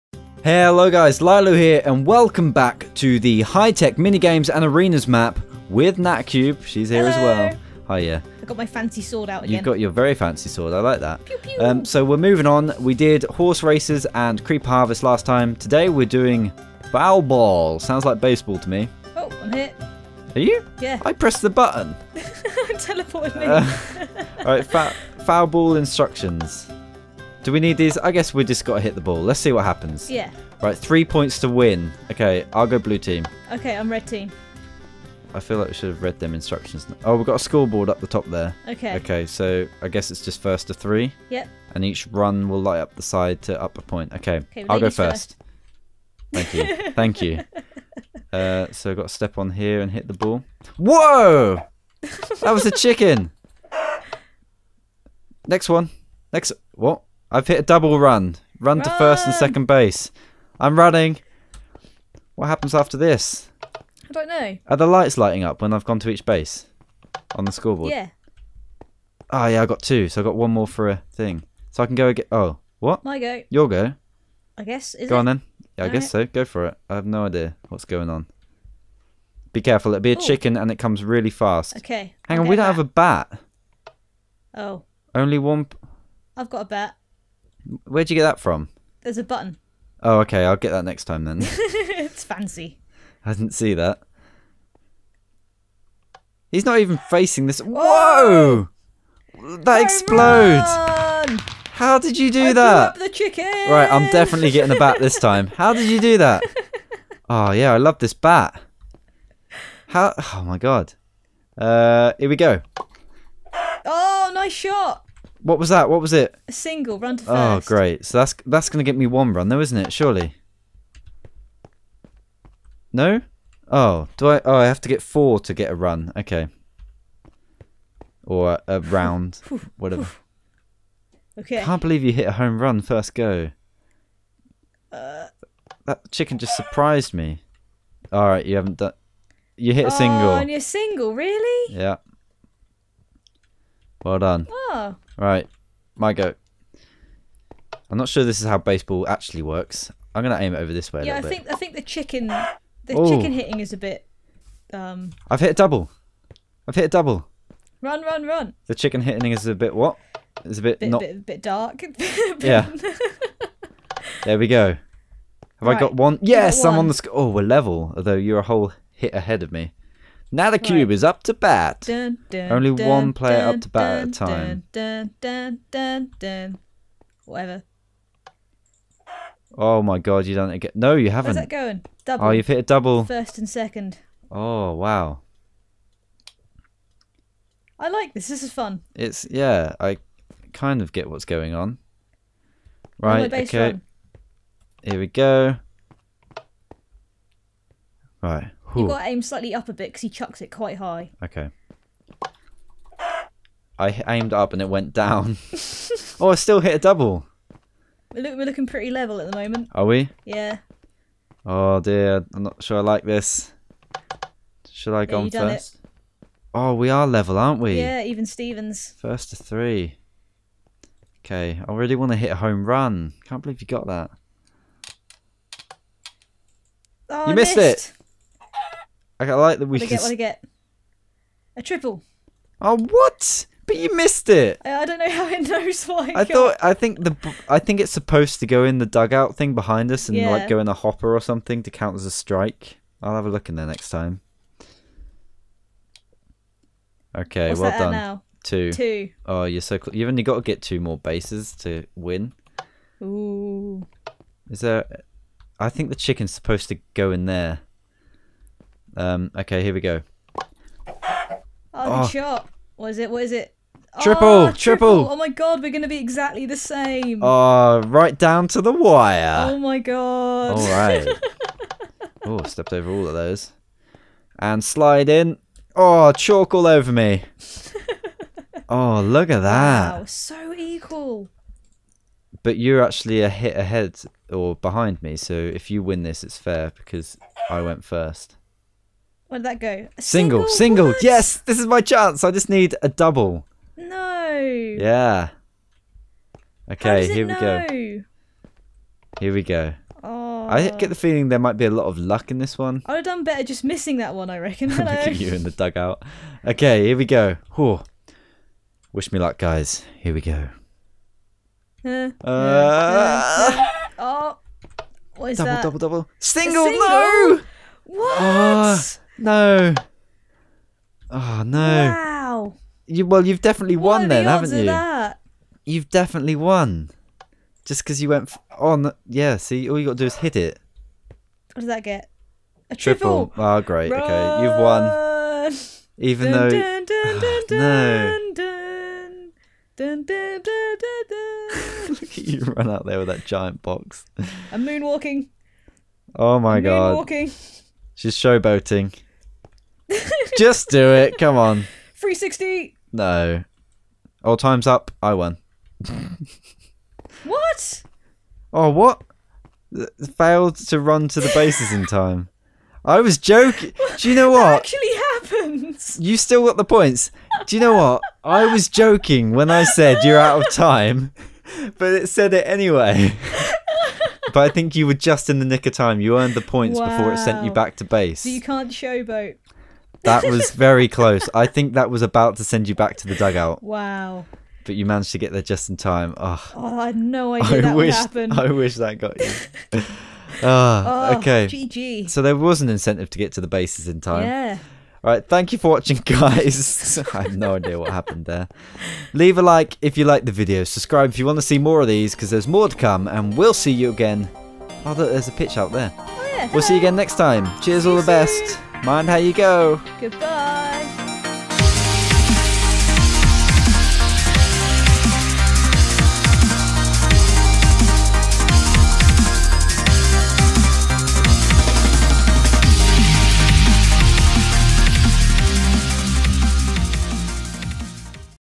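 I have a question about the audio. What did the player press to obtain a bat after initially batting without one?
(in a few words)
A button.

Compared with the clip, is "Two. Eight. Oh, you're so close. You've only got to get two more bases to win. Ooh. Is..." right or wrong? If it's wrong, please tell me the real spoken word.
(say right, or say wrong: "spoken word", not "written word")
wrong: "Two", not "Eight".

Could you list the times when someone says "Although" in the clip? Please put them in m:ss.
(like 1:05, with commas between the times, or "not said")
2:47.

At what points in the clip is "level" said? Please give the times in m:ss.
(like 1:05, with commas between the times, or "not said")
2:47, 3:28, 3:37.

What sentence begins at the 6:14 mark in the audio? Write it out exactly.
but I think you were just in the nick of time.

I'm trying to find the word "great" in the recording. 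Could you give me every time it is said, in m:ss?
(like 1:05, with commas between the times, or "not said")
1:57, 5:33.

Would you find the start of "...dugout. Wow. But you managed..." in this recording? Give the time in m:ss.
6:23.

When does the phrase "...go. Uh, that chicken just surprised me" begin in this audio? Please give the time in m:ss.
2:13.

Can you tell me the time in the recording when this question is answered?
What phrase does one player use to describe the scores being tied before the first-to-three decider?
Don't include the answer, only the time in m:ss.
3:38.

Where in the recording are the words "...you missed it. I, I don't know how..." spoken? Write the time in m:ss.
3:53.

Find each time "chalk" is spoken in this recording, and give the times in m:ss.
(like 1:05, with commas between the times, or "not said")
4:36.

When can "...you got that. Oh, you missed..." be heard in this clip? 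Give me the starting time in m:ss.
3:43.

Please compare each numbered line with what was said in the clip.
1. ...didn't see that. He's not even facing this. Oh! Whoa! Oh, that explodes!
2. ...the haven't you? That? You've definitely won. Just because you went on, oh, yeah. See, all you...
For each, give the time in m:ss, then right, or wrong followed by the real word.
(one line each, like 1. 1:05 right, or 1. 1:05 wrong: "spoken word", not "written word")
1. 1:33 right
2. 5:24 right.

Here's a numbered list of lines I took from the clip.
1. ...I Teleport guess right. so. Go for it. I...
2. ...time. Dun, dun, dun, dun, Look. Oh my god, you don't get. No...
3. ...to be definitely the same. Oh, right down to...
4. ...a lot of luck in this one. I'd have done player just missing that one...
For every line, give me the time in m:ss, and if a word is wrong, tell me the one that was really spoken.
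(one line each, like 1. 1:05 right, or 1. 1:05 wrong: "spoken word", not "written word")
1. 1:15 wrong: "All", not "Teleport"
2. 2:54 wrong: "Whatever", not "Look"
3. 4:25 wrong: "exactly", not "definitely"
4. 5:01 wrong: "better", not "player".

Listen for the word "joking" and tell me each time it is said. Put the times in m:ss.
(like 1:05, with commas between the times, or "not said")
6:03, 6:08.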